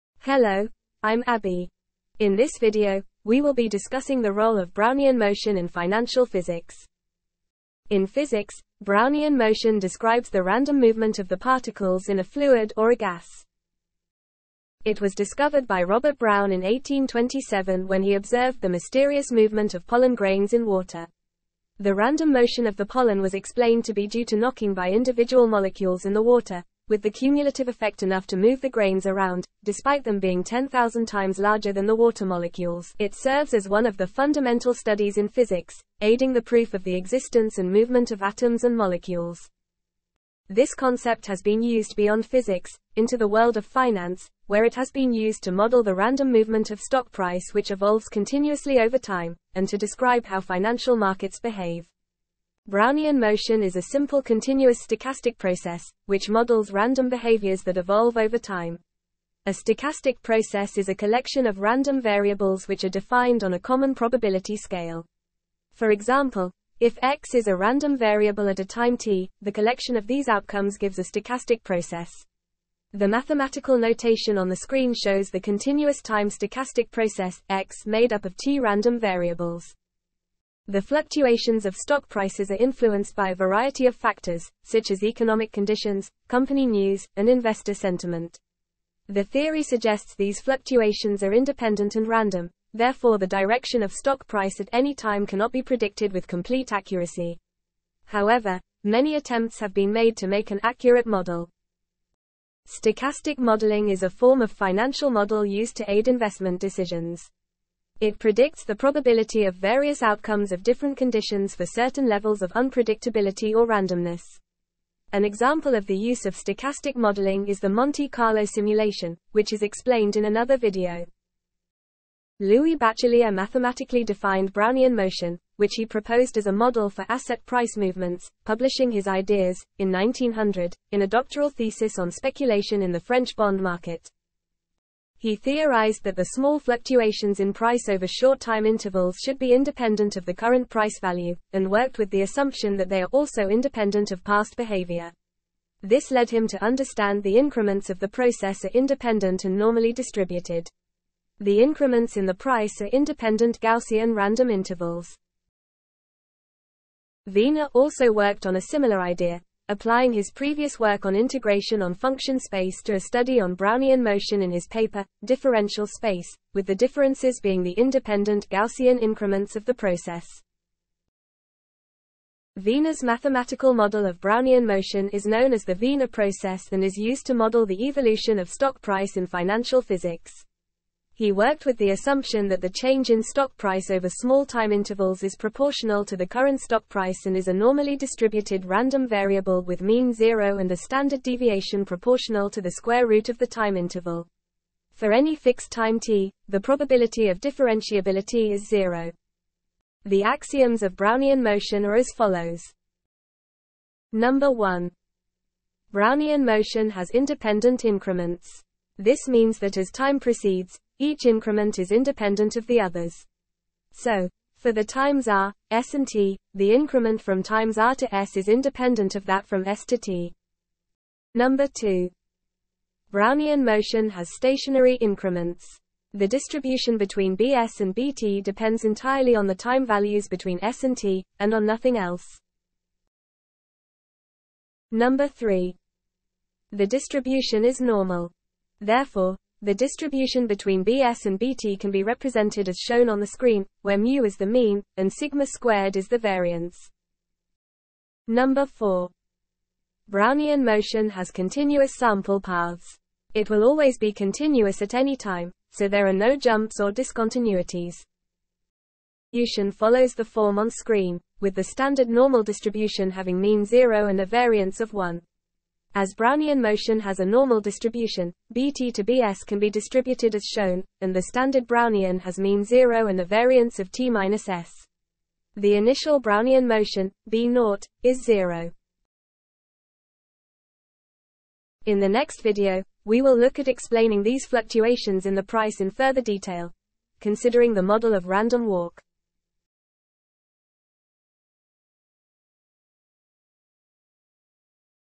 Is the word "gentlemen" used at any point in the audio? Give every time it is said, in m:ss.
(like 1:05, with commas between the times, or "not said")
not said.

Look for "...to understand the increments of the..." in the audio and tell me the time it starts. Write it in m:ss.
2:26.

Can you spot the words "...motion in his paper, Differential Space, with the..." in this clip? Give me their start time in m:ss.
2:44.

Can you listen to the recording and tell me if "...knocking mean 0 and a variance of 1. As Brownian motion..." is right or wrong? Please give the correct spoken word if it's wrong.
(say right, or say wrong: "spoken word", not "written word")
wrong: "having", not "knocking".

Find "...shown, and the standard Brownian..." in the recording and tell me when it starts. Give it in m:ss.
4:30.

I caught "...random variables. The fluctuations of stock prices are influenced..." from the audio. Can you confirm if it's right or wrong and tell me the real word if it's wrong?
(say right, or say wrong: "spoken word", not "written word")
right.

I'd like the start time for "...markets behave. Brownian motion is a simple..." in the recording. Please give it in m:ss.
0:50.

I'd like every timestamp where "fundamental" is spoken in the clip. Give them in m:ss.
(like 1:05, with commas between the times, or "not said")
0:34.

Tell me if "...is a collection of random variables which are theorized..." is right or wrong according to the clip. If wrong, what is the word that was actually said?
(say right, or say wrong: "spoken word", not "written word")
wrong: "defined", not "theorized".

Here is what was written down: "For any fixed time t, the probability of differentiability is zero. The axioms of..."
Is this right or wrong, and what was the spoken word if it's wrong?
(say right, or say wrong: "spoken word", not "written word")
right.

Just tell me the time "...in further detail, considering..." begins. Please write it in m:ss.
4:45.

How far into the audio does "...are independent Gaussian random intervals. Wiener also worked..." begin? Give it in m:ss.
2:32.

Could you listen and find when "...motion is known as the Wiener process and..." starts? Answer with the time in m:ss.
2:54.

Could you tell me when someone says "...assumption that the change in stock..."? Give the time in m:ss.
3:01.